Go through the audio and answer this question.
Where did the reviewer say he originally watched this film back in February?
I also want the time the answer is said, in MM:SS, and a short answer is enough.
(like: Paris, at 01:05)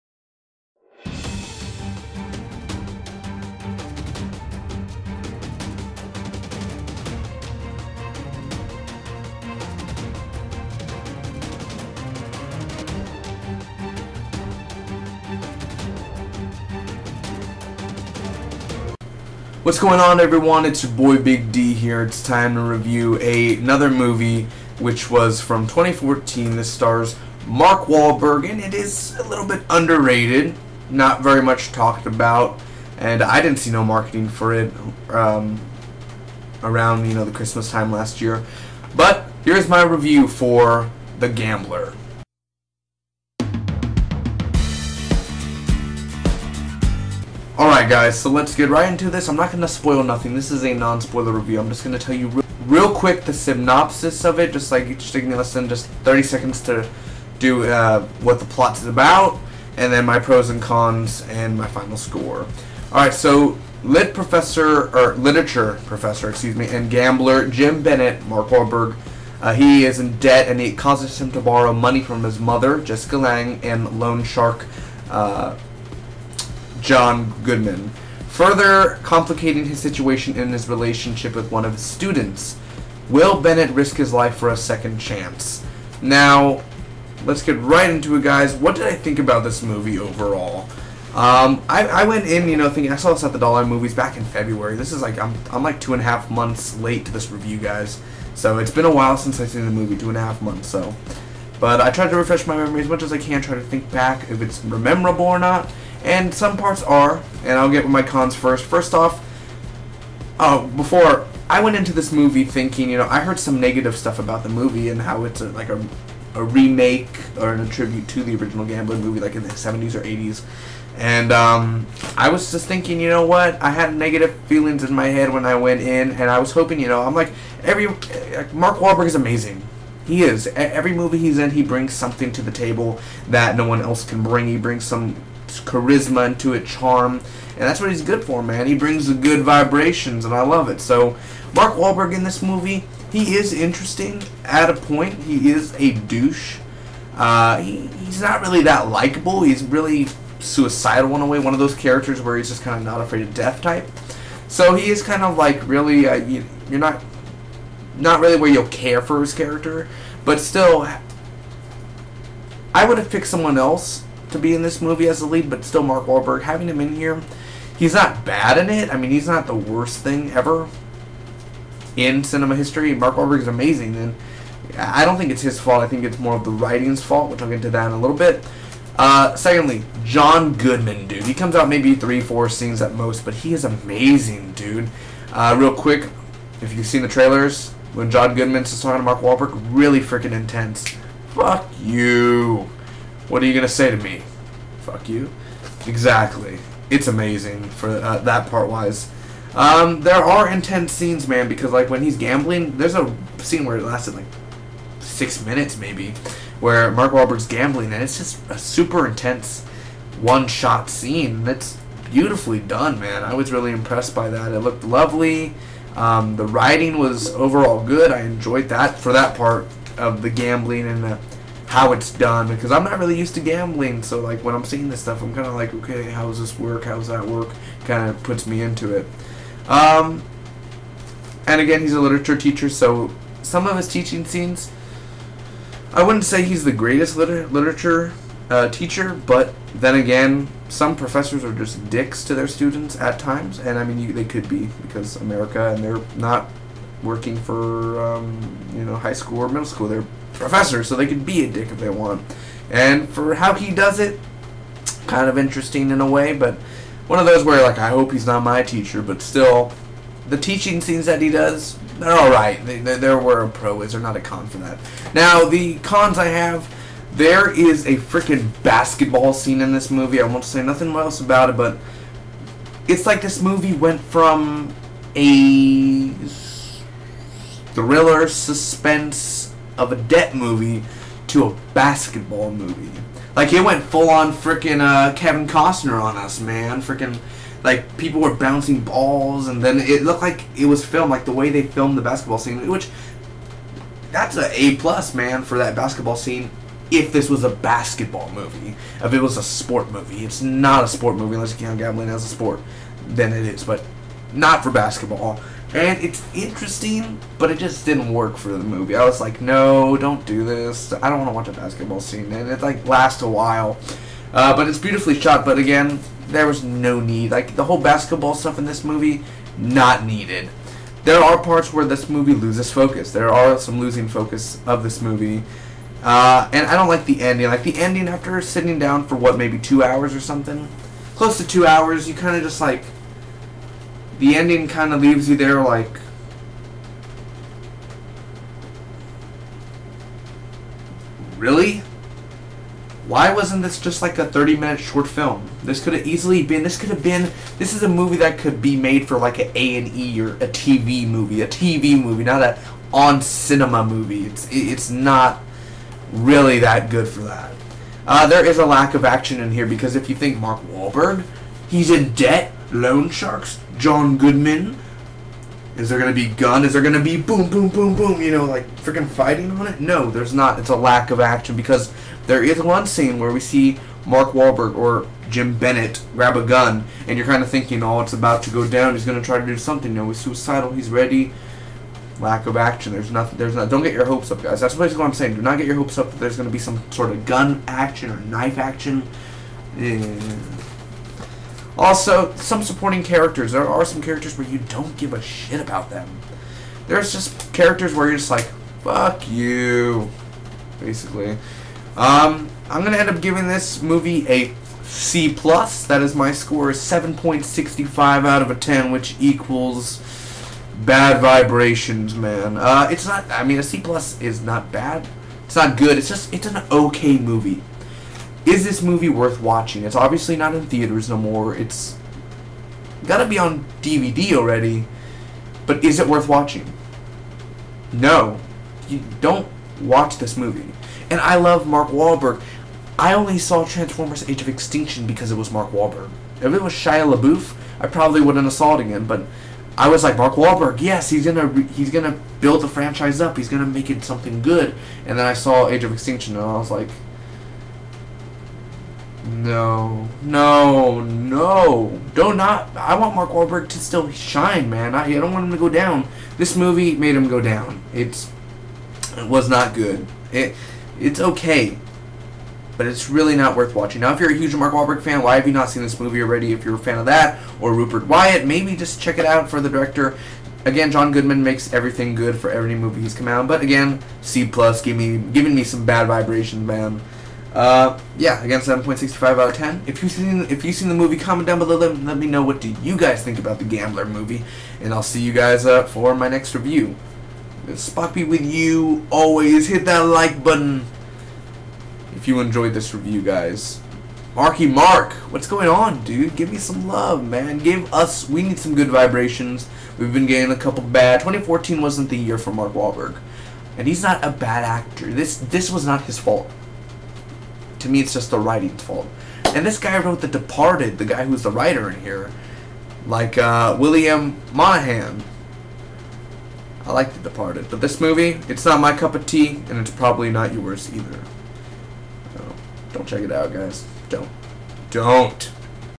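the Dollar Movies, at 01:33.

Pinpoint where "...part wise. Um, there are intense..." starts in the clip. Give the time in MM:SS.
03:18.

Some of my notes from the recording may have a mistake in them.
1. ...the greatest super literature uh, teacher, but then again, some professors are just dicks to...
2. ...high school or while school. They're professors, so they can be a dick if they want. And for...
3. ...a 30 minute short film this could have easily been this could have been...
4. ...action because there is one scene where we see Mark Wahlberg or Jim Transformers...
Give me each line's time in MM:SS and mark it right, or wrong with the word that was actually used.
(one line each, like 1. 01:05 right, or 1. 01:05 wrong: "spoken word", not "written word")
1. 03:56 wrong: "liter", not "super"
2. 04:08 wrong: "middle", not "while"
3. 05:44 right
4. 06:11 wrong: "Bennett", not "Transformers".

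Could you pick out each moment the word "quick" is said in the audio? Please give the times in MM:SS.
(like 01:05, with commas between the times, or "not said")
00:52, 03:05.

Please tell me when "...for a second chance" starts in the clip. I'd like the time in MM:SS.
01:24.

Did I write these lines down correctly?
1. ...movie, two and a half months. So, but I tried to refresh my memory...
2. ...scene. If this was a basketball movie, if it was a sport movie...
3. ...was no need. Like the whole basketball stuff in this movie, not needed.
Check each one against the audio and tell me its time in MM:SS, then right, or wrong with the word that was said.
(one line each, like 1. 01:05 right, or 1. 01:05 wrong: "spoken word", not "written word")
1. 01:39 right
2. 04:56 right
3. 05:16 right.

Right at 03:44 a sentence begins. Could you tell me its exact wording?
So like when I'm seeing this stuff, I'm kind of like, okay, how does this work?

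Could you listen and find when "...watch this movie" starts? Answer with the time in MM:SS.
07:09.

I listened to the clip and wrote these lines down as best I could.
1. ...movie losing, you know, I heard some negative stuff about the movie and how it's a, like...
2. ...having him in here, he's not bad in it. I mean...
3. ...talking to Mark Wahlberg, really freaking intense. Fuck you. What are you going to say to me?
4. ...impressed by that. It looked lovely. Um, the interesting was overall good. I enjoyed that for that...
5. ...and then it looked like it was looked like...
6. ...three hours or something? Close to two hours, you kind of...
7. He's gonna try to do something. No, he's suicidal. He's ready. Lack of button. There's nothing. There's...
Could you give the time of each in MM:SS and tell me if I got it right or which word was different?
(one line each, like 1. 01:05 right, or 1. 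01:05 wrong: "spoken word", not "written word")
1. 01:52 wrong: "thinking", not "losing"
2. 02:46 right
3. 03:08 right
4. 03:33 wrong: "writing", not "interesting"
5. 04:49 wrong: "filmed", not "looked"
6. 05:29 wrong: "two", not "three"
7. 06:18 wrong: "action", not "button".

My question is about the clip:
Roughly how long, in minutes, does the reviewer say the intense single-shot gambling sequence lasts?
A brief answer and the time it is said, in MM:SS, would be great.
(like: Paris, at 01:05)
6 minutes, at 03:24.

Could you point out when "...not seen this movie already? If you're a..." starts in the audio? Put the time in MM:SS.
07:45.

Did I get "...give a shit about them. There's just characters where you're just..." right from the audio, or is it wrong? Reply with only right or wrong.
right.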